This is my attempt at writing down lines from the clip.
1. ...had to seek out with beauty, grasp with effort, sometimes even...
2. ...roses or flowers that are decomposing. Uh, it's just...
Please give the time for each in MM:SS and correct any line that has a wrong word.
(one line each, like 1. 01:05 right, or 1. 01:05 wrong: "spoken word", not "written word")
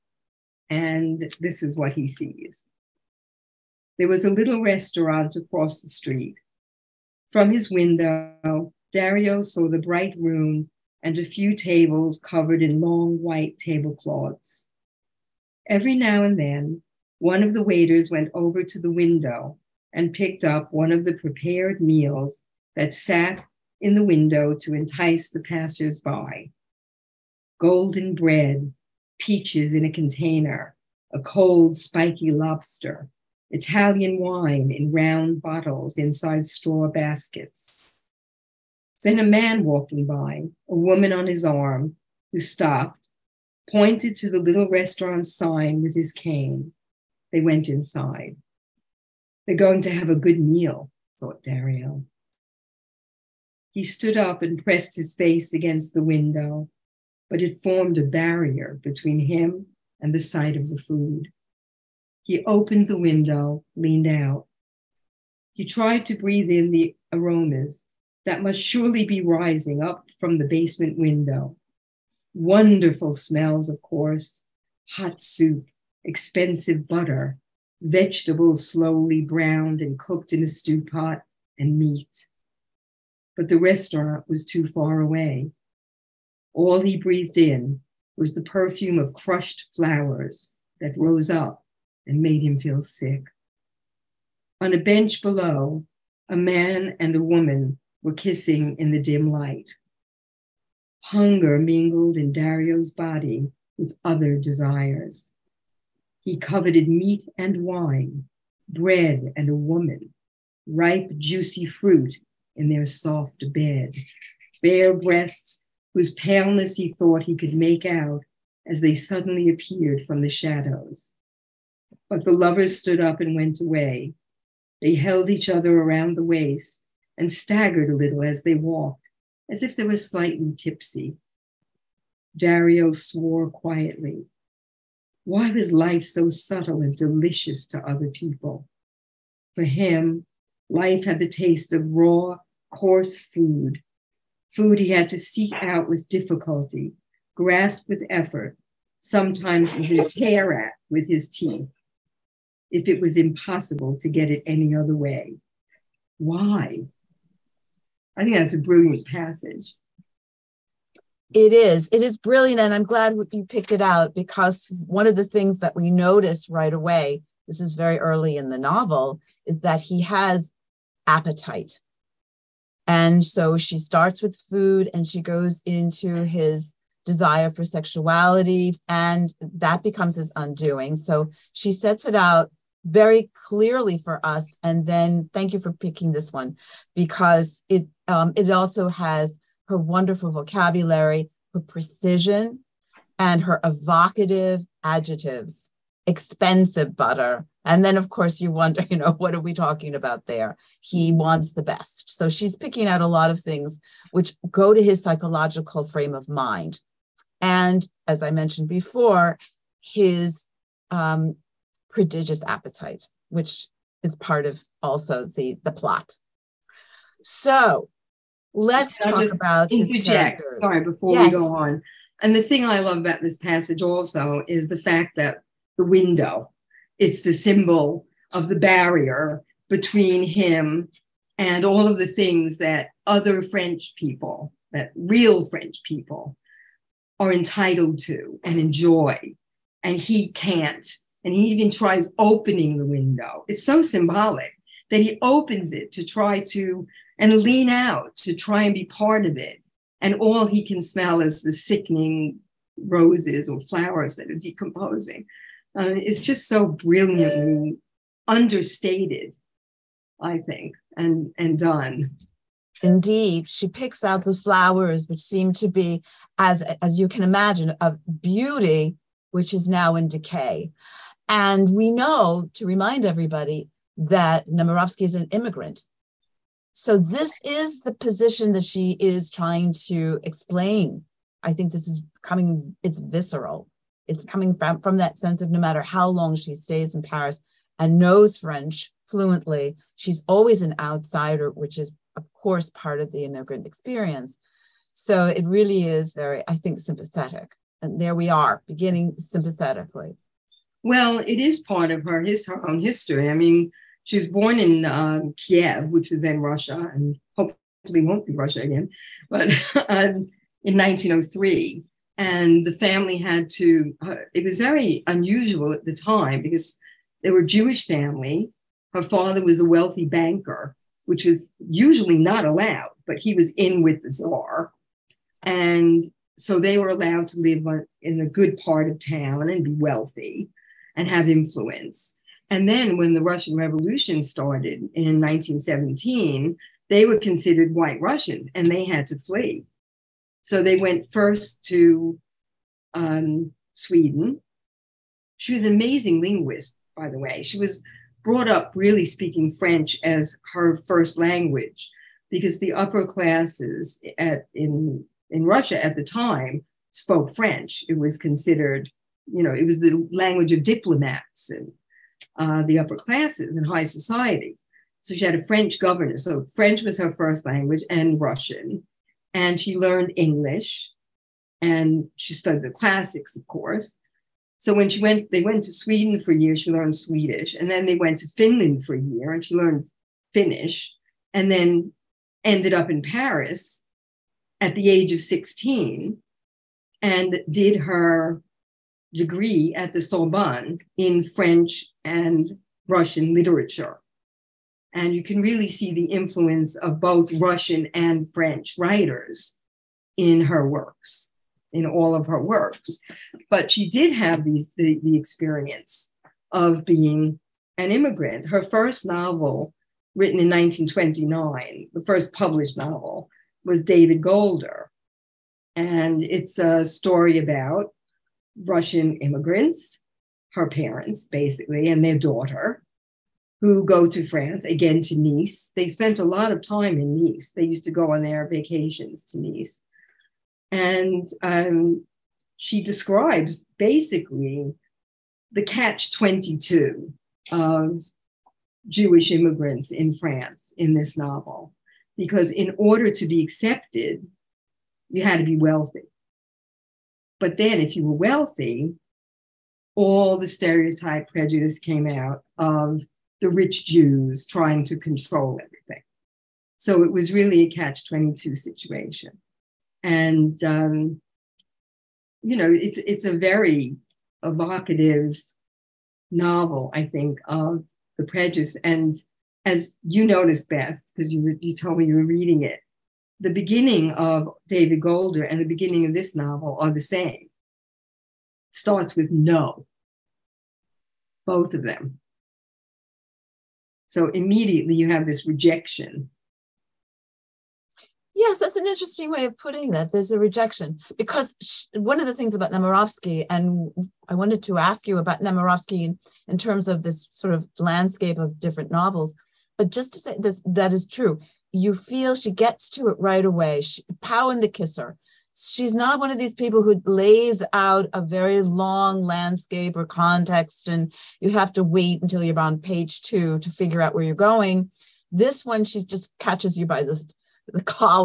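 1. 02:24 wrong: "difficulty", not "beauty"
2. 04:12 right.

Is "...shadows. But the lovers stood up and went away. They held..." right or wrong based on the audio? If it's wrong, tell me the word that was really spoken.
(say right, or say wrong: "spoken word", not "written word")
right.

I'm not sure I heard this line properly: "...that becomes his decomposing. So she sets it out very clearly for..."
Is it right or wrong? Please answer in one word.
wrong.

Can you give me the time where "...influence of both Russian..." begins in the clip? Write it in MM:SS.
06:36.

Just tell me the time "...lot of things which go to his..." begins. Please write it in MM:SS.
03:23.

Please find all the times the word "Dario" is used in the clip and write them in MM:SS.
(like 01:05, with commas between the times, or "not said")
00:08, 00:51, 01:42, 02:12.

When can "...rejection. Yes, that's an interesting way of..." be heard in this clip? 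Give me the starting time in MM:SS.
08:05.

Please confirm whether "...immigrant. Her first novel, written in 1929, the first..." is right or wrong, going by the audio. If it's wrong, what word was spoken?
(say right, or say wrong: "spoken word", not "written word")
right.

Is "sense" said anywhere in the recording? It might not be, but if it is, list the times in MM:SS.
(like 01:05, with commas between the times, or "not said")
04:45.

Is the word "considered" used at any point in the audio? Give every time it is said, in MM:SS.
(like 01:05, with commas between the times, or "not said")
05:37, 05:58.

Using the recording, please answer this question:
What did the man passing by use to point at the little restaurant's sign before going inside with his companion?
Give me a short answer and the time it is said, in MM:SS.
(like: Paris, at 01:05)
His cane, at 00:45.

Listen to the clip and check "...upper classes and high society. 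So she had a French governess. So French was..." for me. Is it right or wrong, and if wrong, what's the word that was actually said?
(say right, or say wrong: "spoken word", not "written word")
right.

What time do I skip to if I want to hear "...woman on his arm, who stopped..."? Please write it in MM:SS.
00:40.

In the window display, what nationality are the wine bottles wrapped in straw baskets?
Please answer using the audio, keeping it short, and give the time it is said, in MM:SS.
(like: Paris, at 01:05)
Italian, at 00:33.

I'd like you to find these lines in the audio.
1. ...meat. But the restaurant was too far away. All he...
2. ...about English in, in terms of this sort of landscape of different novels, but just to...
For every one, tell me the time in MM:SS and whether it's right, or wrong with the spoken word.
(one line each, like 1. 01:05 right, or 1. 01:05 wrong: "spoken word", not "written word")
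1. 01:21 right
2. 08:15 wrong: "Nemirovsky", not "English".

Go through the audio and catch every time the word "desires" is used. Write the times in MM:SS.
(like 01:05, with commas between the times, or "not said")
01:44, 02:57.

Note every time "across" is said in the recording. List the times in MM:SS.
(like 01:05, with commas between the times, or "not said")
00:05.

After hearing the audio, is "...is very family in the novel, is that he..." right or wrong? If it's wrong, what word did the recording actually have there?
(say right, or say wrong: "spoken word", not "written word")
wrong: "early", not "family".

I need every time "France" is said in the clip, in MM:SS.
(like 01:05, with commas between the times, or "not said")
07:04, 07:20.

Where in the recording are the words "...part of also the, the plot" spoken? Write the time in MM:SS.
03:34.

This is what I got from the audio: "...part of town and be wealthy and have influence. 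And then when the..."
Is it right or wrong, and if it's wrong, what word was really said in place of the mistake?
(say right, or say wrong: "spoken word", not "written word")
right.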